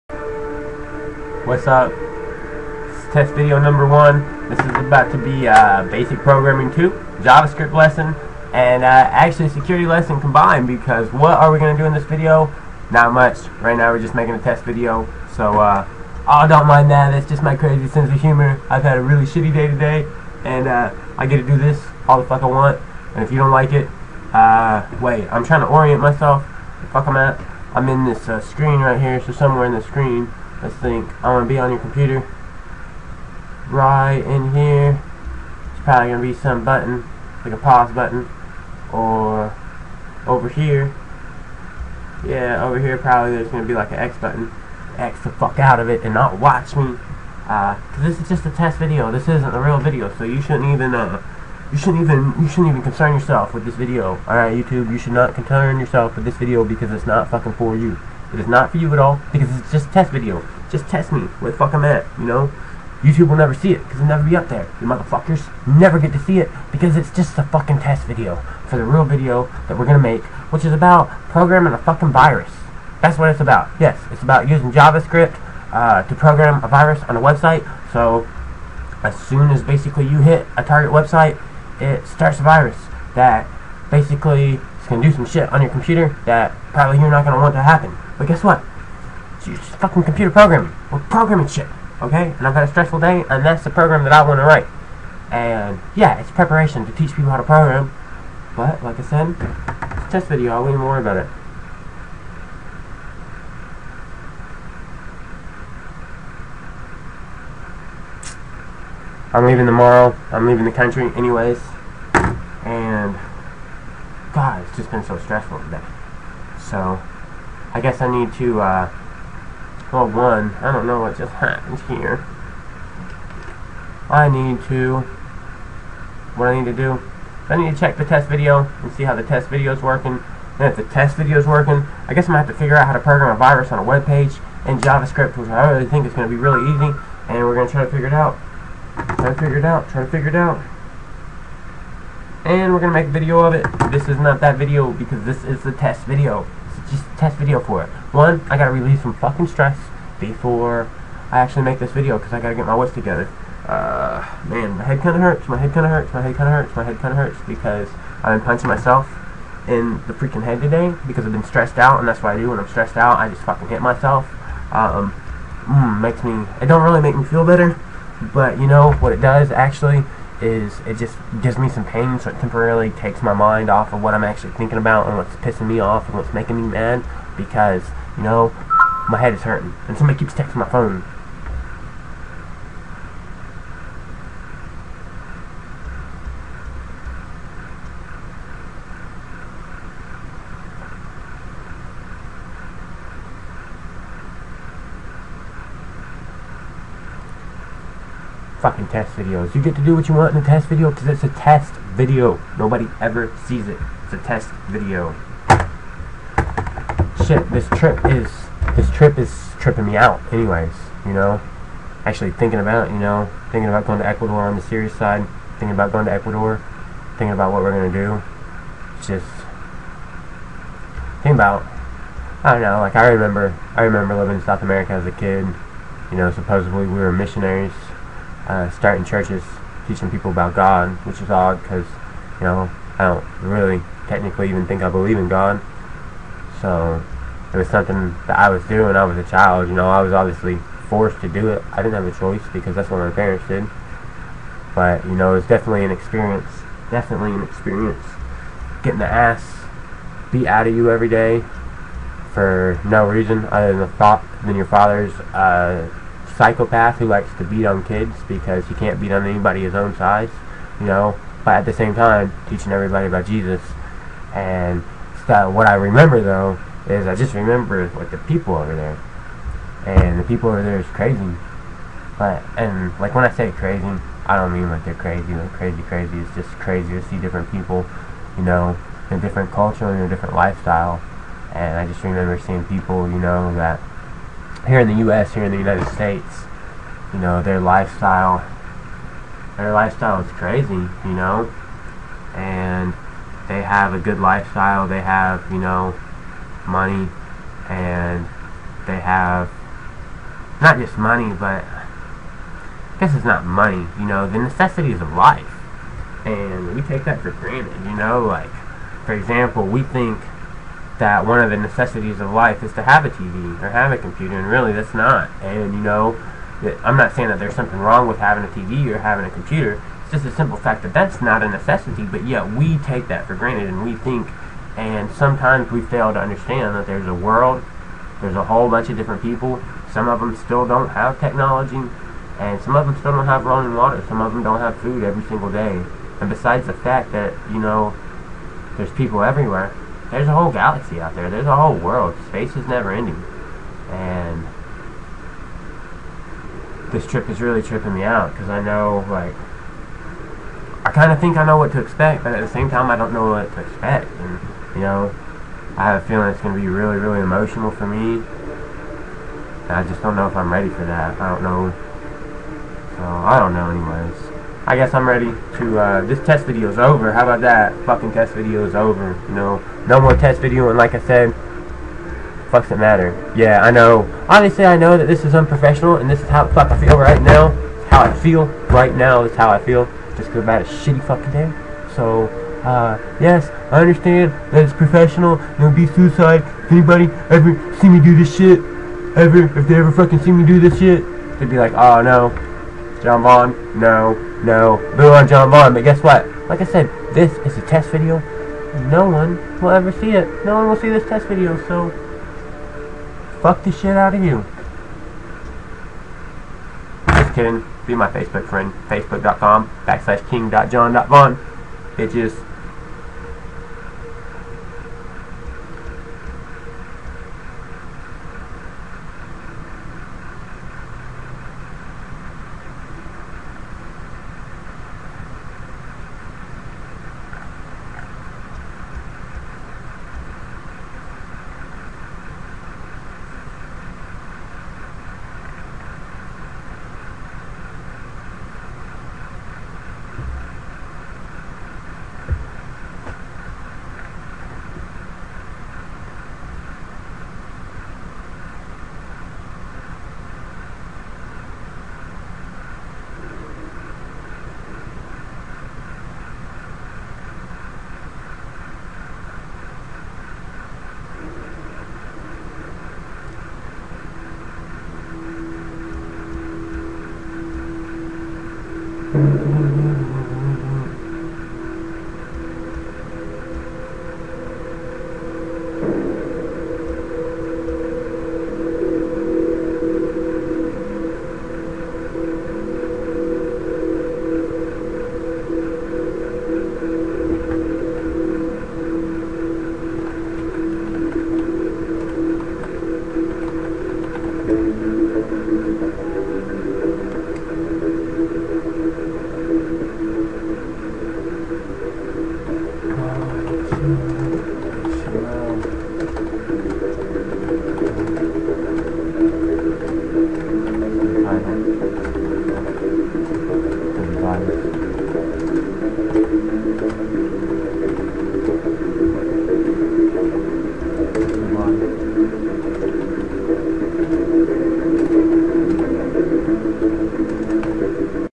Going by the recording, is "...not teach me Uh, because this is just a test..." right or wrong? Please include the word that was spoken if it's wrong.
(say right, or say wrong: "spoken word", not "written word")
wrong: "watch", not "teach".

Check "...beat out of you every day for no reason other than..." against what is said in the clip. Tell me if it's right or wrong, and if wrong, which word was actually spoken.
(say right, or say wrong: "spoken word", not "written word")
right.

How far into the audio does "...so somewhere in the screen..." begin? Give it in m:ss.
0:29.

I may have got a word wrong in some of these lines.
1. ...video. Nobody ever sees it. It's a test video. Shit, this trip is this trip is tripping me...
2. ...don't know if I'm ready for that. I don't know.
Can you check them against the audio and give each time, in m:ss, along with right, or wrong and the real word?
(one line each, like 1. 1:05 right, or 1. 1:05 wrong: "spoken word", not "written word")
1. 3:21 right
2. 6:00 right.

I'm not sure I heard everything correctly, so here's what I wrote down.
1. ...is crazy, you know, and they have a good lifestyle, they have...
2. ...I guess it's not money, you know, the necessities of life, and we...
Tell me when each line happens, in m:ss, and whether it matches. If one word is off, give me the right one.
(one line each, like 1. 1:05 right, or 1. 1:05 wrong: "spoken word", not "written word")
1. 4:50 right
2. 5:01 right.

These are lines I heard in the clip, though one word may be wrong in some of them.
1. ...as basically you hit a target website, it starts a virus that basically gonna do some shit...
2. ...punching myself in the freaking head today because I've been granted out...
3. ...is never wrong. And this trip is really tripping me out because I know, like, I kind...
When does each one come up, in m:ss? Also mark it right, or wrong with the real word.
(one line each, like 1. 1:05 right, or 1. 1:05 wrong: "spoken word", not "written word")
1. 1:19 right
2. 2:38 wrong: "stressed", not "granted"
3. 5:42 wrong: "ending", not "wrong".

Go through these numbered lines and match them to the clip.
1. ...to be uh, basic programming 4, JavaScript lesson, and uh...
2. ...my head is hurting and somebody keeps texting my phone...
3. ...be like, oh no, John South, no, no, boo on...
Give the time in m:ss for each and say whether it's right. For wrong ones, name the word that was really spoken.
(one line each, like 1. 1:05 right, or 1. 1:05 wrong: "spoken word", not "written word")
1. 0:05 wrong: "2", not "4"
2. 2:59 right
3. 6:31 wrong: "Vaughn", not "South".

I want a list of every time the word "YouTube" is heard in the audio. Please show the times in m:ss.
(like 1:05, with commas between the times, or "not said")
0:54, 1:03.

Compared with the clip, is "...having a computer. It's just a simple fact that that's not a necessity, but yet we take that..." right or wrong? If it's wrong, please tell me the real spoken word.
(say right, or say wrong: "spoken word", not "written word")
right.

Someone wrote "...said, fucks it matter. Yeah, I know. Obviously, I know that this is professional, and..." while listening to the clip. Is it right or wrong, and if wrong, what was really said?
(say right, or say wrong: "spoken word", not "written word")
wrong: "unprofessional", not "professional".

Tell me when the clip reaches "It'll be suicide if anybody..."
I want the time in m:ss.
6:25.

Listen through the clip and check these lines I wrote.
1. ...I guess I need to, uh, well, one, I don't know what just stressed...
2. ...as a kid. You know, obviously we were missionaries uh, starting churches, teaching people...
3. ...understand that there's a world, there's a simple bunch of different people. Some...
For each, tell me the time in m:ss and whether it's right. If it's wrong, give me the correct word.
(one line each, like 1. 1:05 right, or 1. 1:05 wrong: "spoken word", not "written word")
1. 1:57 wrong: "happened", not "stressed"
2. 3:44 wrong: "supposedly", not "obviously"
3. 5:26 wrong: "whole", not "simple".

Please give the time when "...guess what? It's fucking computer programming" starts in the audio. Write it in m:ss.
1:28.